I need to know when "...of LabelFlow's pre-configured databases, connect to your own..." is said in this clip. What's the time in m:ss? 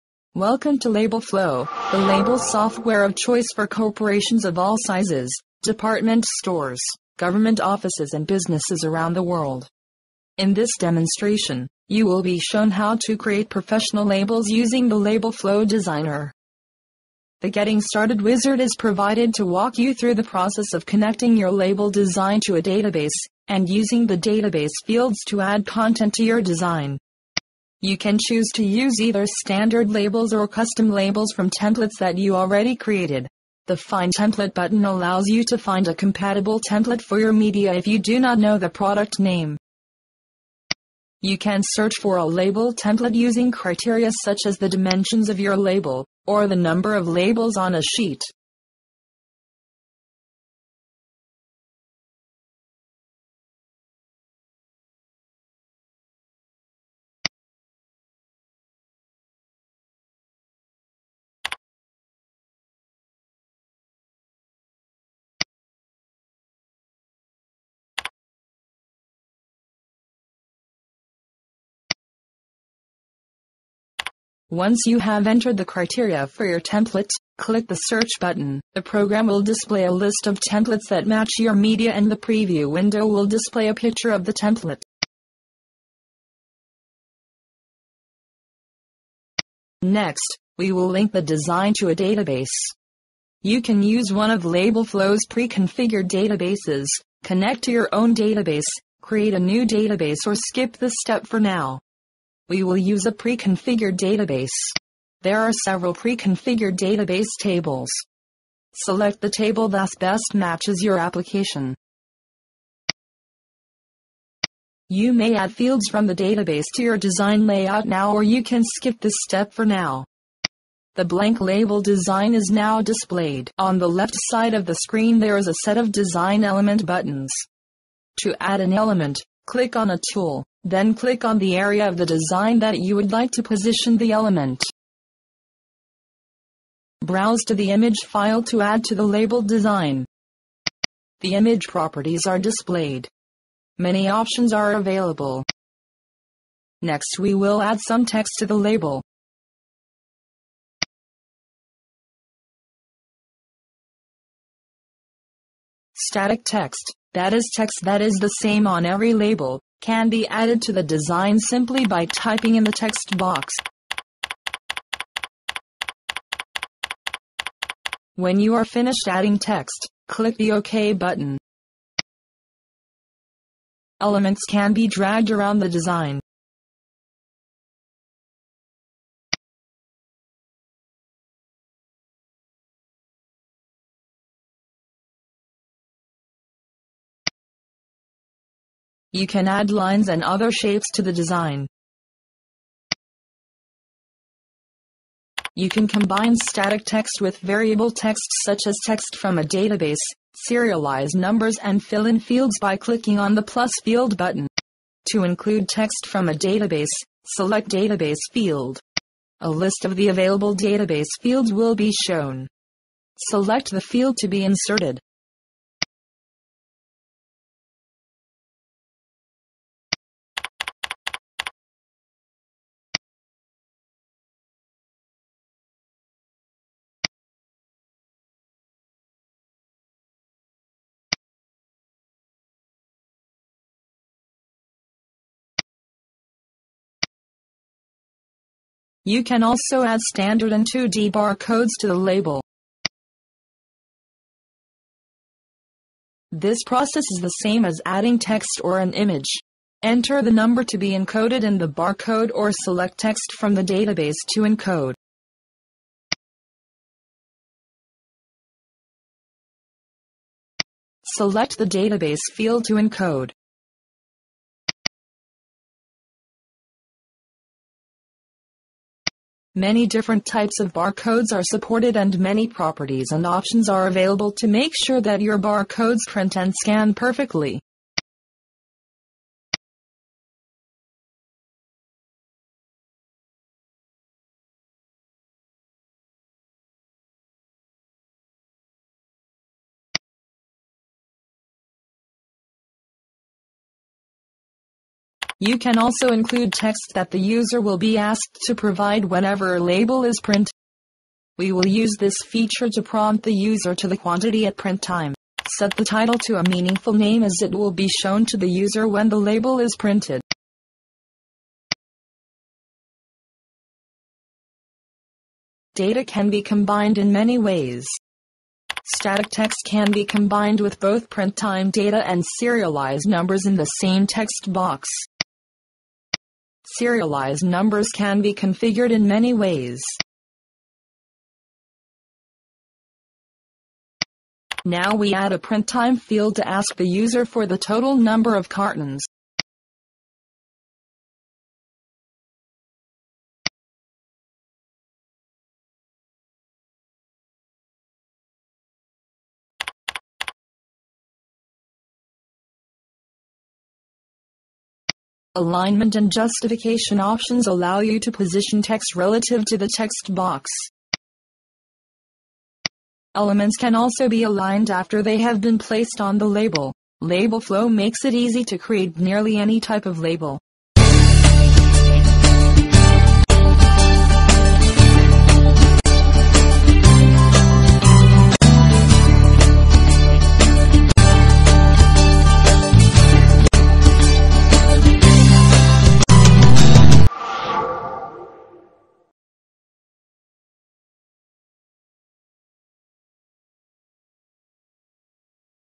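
1:34.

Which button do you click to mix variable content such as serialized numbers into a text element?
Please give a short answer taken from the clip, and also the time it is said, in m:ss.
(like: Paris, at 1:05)
plus field, at 3:23.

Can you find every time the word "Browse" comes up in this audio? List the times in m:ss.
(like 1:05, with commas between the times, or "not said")
2:17.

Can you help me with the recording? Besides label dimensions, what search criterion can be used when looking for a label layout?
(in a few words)
number of labels on a sheet.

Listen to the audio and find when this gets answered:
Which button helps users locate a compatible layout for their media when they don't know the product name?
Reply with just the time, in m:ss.
0:33.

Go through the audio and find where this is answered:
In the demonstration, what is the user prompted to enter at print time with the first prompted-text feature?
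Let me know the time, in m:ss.
5:03.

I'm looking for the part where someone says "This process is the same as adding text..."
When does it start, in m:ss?
4:06.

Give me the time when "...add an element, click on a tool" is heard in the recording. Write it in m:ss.
2:08.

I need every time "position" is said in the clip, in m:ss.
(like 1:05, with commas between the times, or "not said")
2:13, 5:58.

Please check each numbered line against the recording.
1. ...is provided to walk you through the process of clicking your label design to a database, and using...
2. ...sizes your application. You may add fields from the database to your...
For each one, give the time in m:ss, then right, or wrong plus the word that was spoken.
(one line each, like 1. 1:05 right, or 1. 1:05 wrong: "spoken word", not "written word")
1. 0:18 wrong: "connecting", not "clicking"
2. 1:50 wrong: "matches", not "sizes".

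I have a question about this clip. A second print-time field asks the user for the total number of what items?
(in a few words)
cartons.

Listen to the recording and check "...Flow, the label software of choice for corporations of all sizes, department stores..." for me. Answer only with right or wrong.
right.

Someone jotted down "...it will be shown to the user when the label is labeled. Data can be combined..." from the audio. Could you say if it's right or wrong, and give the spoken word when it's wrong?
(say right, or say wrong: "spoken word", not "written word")
wrong: "printed", not "labeled".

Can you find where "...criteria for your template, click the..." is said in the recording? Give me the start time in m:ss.
1:15.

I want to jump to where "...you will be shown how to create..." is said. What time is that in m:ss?
0:11.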